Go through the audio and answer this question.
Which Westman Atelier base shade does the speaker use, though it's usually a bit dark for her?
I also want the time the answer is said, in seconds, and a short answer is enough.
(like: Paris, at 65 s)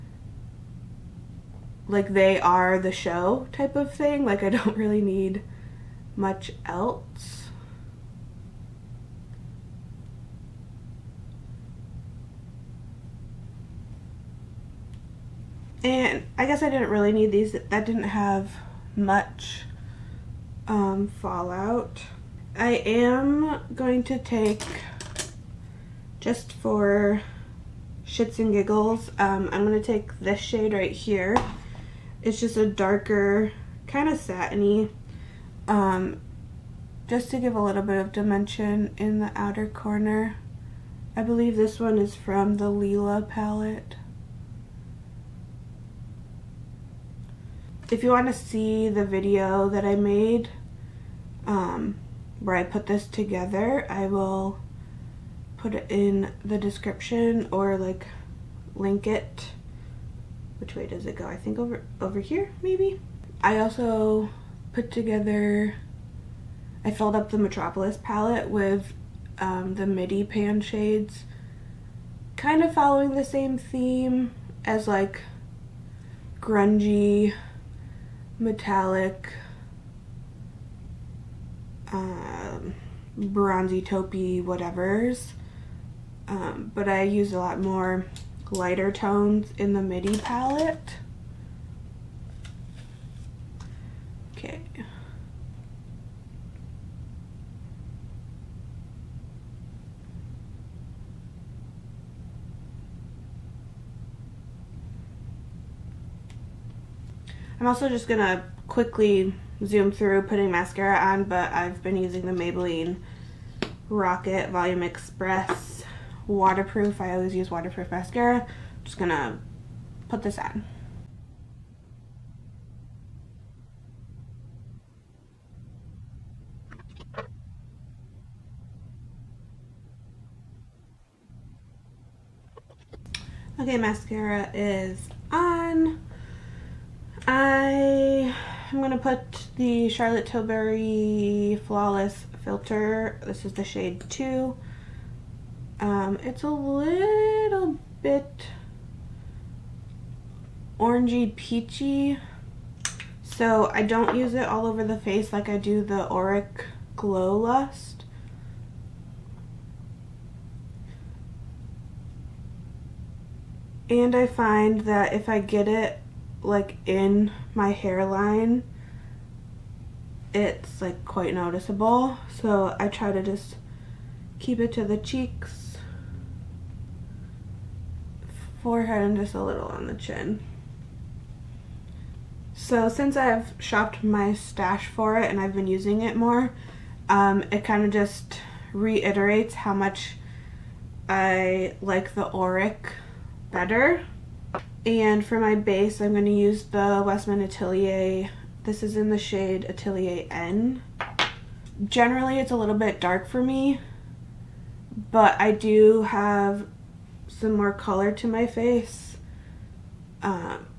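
Atelier N, at 199 s.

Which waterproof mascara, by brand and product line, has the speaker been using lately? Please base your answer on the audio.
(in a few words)
Maybelline Rocket Volume Express.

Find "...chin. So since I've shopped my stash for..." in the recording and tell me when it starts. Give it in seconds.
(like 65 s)
179 s.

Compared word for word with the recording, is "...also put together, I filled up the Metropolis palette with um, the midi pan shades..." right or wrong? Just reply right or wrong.
right.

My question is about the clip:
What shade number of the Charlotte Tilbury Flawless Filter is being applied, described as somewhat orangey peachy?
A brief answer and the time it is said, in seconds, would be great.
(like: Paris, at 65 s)
2, at 143 s.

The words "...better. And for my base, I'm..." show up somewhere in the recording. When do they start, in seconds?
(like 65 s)
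193 s.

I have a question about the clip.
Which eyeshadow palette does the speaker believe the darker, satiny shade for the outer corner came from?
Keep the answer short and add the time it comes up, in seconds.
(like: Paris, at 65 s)
Leela palette, at 42 s.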